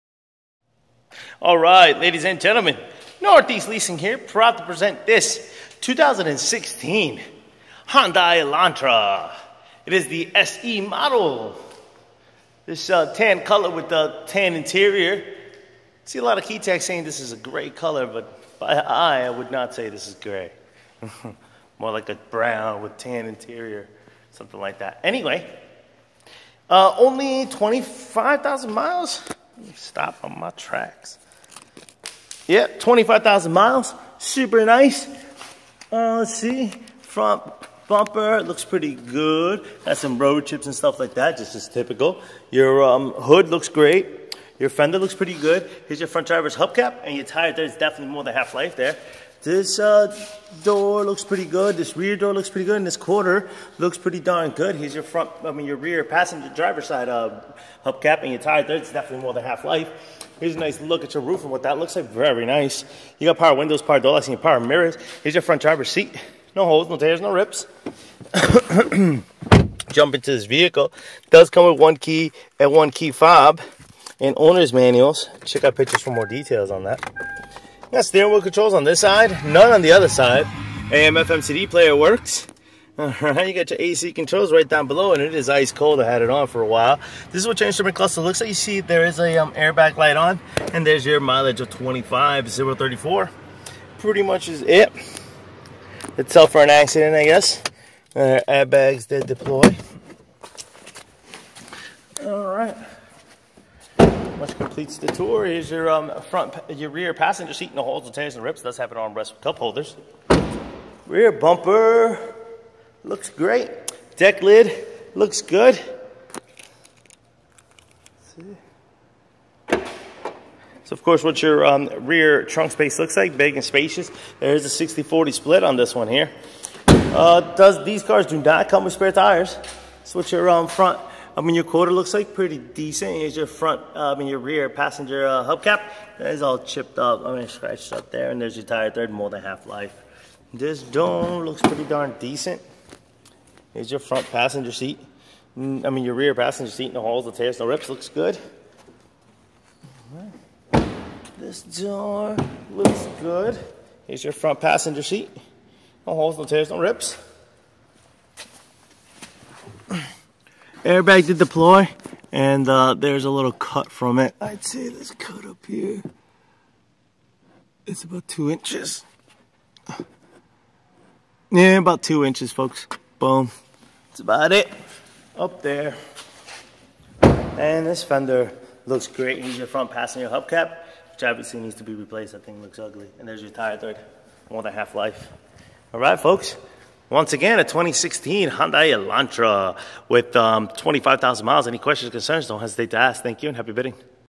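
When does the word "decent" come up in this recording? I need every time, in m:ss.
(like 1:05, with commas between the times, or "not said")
2:12, 2:22.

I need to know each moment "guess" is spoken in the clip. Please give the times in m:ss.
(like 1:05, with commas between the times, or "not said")
1:37.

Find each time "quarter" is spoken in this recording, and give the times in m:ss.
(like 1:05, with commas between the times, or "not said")
0:52, 2:11.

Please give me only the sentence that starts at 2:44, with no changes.
I'd say this cut up here is about two inches.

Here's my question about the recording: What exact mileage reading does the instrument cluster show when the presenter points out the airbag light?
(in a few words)
25,034.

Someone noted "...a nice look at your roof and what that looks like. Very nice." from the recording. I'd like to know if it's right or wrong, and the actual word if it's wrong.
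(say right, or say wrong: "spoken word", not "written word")
right.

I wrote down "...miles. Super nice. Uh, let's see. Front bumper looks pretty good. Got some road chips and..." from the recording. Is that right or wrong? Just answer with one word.
right.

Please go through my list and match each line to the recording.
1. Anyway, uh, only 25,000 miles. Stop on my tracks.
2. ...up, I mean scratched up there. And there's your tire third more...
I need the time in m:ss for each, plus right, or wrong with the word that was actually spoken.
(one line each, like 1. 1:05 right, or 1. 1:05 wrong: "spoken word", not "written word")
1. 0:25 right
2. 2:16 right.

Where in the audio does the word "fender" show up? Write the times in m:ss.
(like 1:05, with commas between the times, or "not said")
0:44, 2:58.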